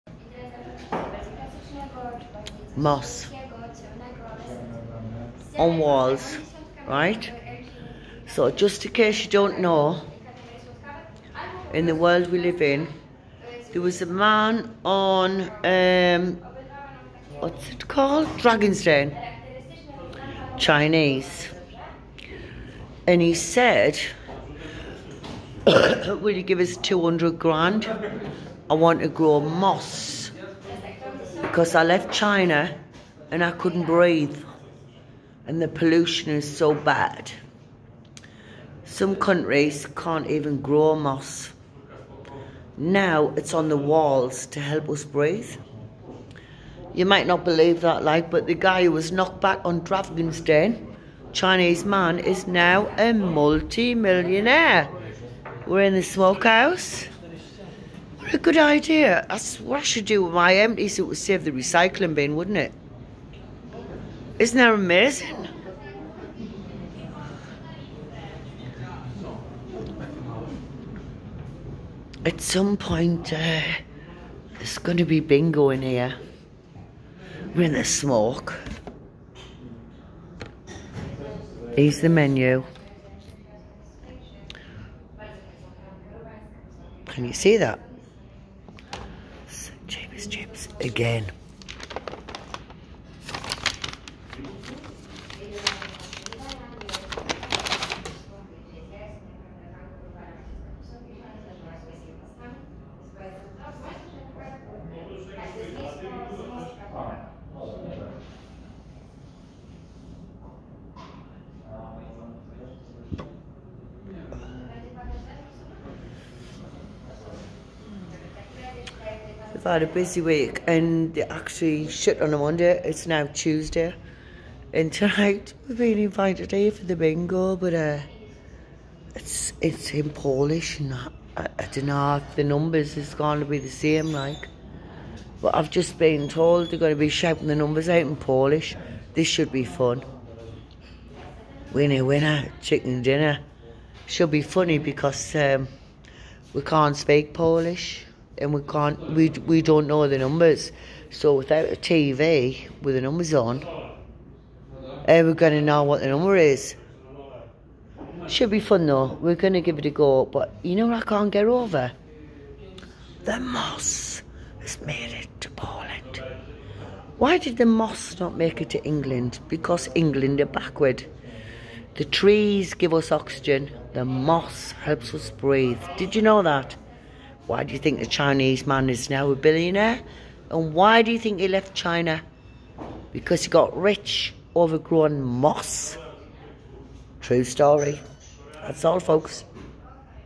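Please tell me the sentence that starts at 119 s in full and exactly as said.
I've had a busy week and they actually shut on a Monday.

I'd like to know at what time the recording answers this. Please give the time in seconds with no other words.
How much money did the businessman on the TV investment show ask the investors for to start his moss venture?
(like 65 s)
26 s.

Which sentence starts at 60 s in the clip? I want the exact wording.
It would save the recycling bin, wouldn't it?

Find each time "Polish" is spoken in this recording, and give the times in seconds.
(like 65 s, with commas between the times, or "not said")
130 s, 138 s, 147 s.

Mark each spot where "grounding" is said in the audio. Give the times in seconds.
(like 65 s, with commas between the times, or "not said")
not said.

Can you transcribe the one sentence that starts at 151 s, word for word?
So without a TV with the numbers on, eh, we we going to know what the number is?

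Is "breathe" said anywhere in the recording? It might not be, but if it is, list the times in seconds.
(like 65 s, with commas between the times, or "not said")
33 s, 45 s, 175 s.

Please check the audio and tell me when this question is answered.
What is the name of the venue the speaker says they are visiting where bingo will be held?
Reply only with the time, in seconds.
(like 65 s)
55 s.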